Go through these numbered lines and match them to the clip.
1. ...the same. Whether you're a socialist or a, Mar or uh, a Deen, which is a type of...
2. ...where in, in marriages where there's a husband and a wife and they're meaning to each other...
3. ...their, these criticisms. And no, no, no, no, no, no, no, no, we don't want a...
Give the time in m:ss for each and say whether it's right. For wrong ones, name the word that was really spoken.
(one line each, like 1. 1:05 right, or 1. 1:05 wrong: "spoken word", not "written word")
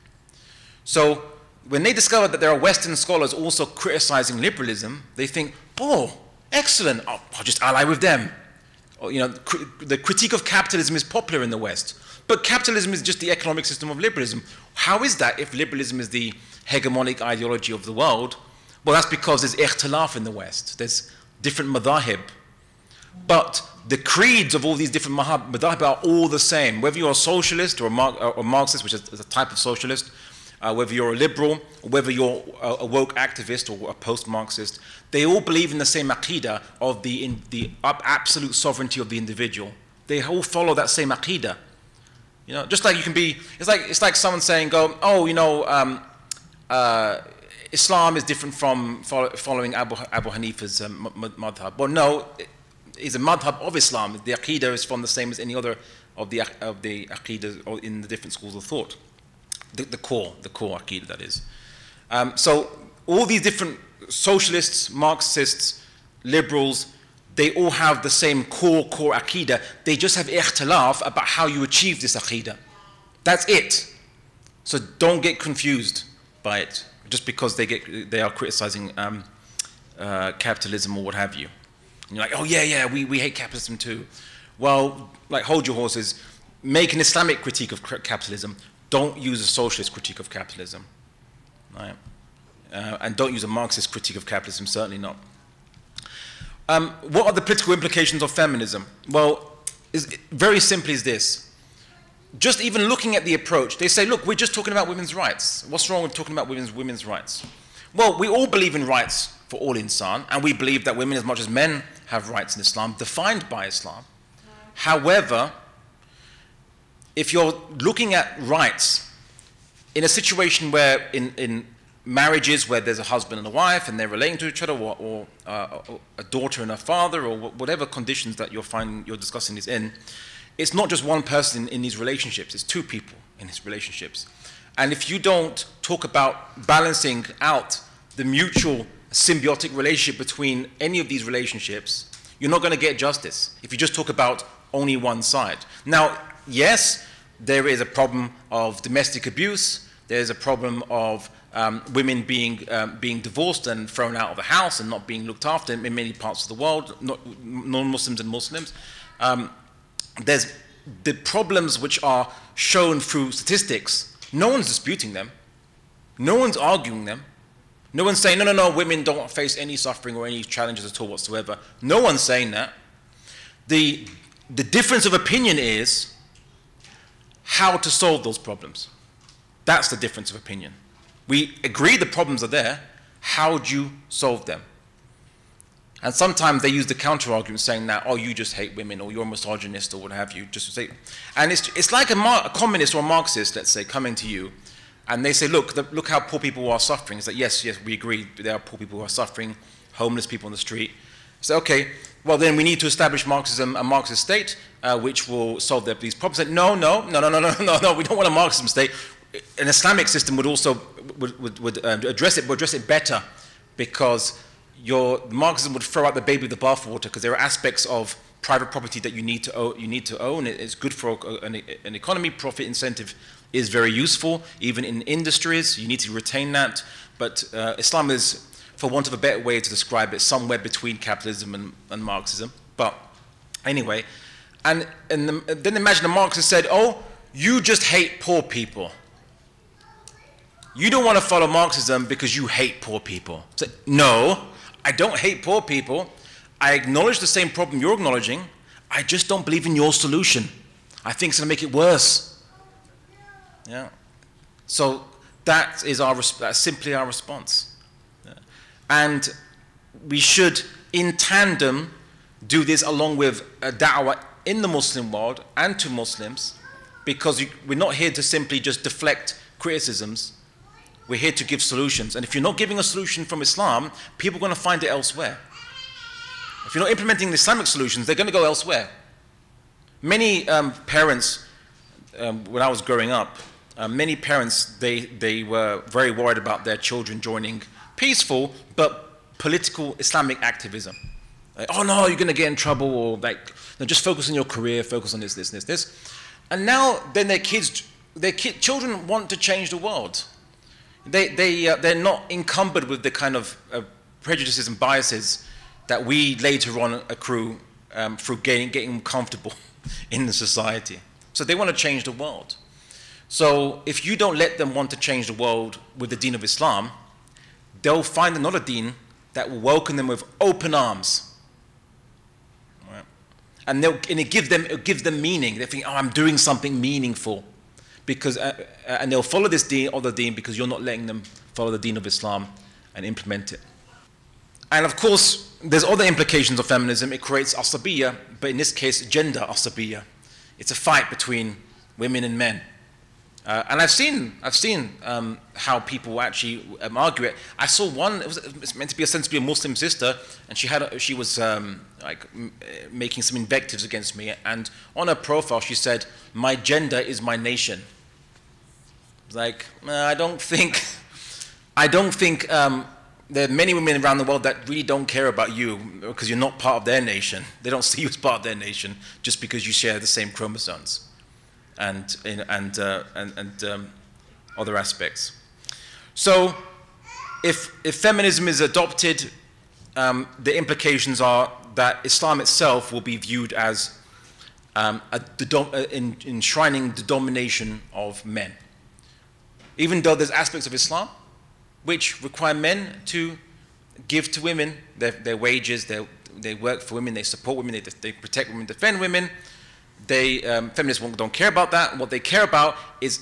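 1. 0:26 wrong: "Marxist", not "Deen"
2. 2:00 wrong: "relating", not "meaning"
3. 3:25 wrong: "problems", not "criticisms".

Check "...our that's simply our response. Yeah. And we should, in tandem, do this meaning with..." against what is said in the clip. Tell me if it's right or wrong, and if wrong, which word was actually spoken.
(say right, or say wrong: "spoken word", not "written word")
wrong: "along", not "meaning".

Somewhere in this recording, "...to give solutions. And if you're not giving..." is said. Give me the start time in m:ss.
4:31.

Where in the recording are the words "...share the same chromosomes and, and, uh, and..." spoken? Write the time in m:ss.
6:09.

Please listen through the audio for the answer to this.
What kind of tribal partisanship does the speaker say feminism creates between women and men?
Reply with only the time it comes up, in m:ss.
5:39.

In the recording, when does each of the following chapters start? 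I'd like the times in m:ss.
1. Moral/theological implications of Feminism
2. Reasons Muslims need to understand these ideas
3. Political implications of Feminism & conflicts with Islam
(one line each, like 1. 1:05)
1. 5:33
2. 4:17
3. 1:34.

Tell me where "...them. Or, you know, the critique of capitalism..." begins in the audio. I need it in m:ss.
0:07.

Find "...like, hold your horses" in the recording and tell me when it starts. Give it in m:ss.
1:25.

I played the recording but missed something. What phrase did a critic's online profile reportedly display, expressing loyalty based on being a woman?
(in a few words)
My gender is my nation.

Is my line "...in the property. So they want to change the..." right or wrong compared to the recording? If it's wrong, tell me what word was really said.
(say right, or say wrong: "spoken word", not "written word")
wrong: "society", not "property".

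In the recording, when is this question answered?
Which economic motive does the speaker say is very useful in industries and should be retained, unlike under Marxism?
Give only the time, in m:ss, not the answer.
3:42.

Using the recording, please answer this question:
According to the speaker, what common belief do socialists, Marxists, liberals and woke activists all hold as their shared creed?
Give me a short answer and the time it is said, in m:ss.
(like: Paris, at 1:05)
absolute sovereignty of the individual, at 0:37.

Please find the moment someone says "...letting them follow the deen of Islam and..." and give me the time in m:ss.
5:30.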